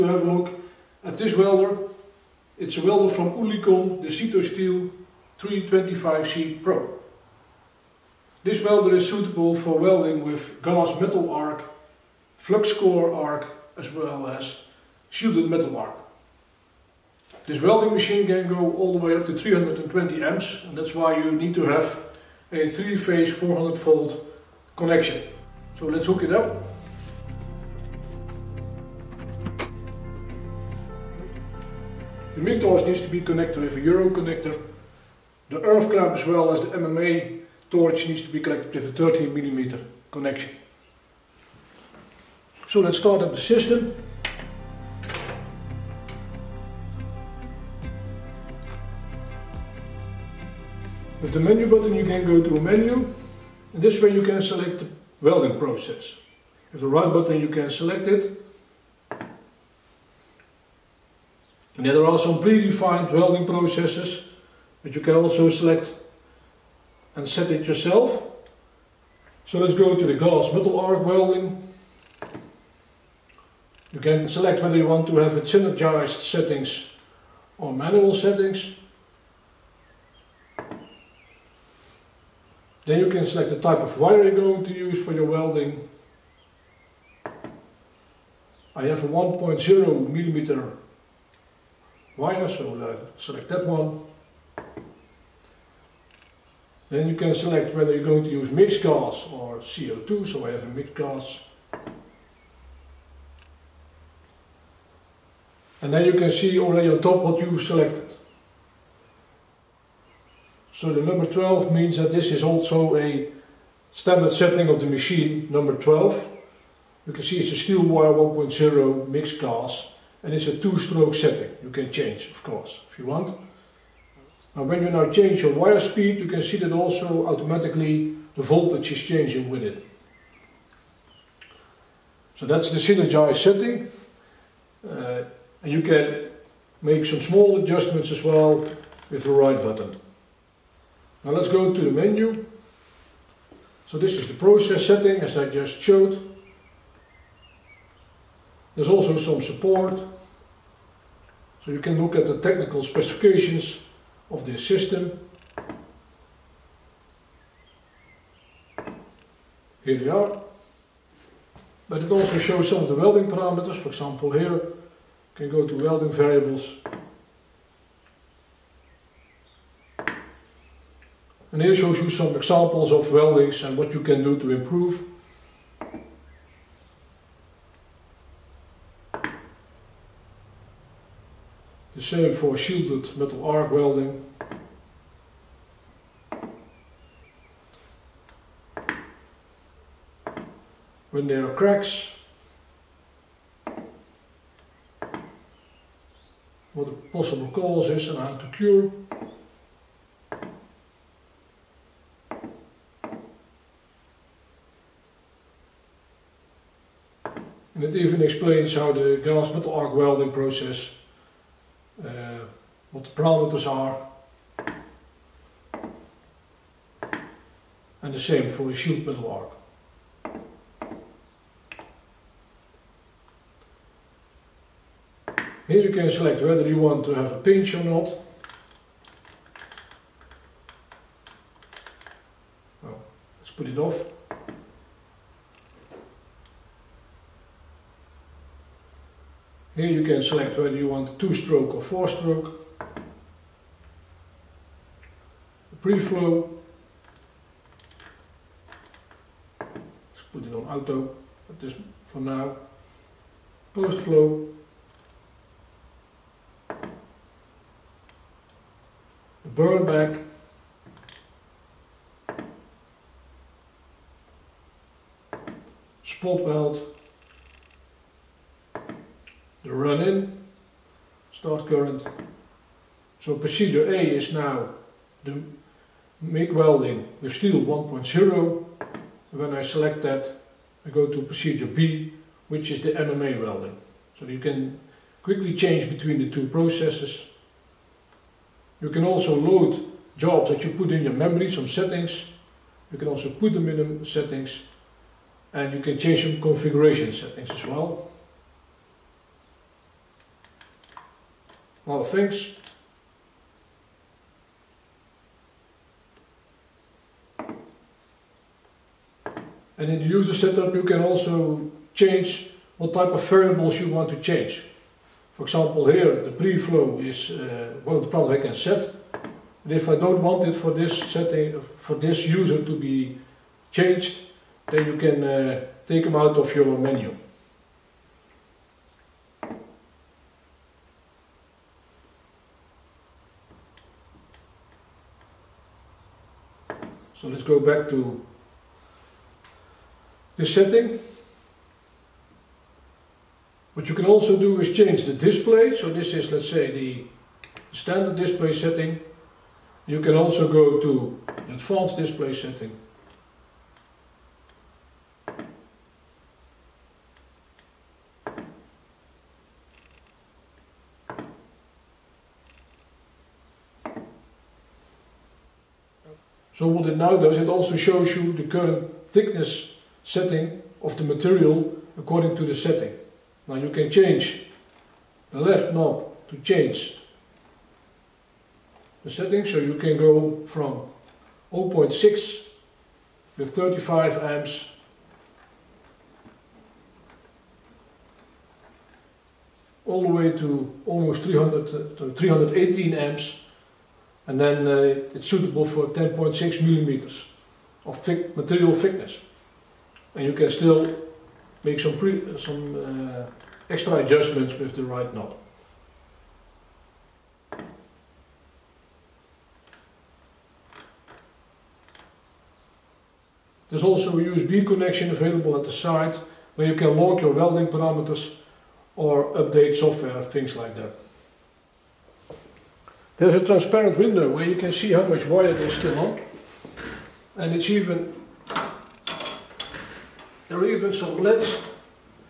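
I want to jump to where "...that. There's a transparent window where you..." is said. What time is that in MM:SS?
07:00.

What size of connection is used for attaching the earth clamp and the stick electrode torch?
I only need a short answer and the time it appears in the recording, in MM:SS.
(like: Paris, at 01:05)
13 mm, at 00:38.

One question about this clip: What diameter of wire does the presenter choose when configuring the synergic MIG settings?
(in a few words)
1.0 millimeter.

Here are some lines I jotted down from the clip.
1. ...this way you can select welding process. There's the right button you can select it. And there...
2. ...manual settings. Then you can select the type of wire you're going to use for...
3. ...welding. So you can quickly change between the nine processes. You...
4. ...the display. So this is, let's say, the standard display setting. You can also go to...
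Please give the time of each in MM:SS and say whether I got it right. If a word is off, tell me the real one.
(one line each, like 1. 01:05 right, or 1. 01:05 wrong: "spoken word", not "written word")
1. 00:53 right
2. 01:17 right
3. 04:43 wrong: "two", not "nine"
4. 05:45 right.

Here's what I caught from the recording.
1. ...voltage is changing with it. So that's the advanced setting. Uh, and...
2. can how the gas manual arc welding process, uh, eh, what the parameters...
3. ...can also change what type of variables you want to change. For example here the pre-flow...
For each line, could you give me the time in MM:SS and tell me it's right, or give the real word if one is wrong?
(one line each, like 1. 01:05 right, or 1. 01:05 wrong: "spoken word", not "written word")
1. 02:08 wrong: "synergized", not "advanced"
2. 03:28 wrong: "metal", not "manual"
3. 05:10 right.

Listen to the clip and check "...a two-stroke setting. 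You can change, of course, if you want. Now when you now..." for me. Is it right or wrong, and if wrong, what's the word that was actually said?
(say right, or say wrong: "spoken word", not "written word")
right.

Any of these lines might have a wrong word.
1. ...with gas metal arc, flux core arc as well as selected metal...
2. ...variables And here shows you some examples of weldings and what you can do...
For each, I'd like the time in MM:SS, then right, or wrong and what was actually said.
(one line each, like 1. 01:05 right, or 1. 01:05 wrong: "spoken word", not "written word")
1. 00:10 wrong: "shielded", not "selected"
2. 02:46 right.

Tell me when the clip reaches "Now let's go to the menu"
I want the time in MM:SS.
02:21.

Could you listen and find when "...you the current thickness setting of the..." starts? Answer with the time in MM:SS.
06:08.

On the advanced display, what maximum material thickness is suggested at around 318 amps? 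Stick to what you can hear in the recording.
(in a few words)
10.6 mm.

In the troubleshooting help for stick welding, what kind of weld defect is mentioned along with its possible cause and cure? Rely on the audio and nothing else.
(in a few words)
Cracks.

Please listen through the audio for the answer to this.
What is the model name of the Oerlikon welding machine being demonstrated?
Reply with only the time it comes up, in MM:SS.
00:04.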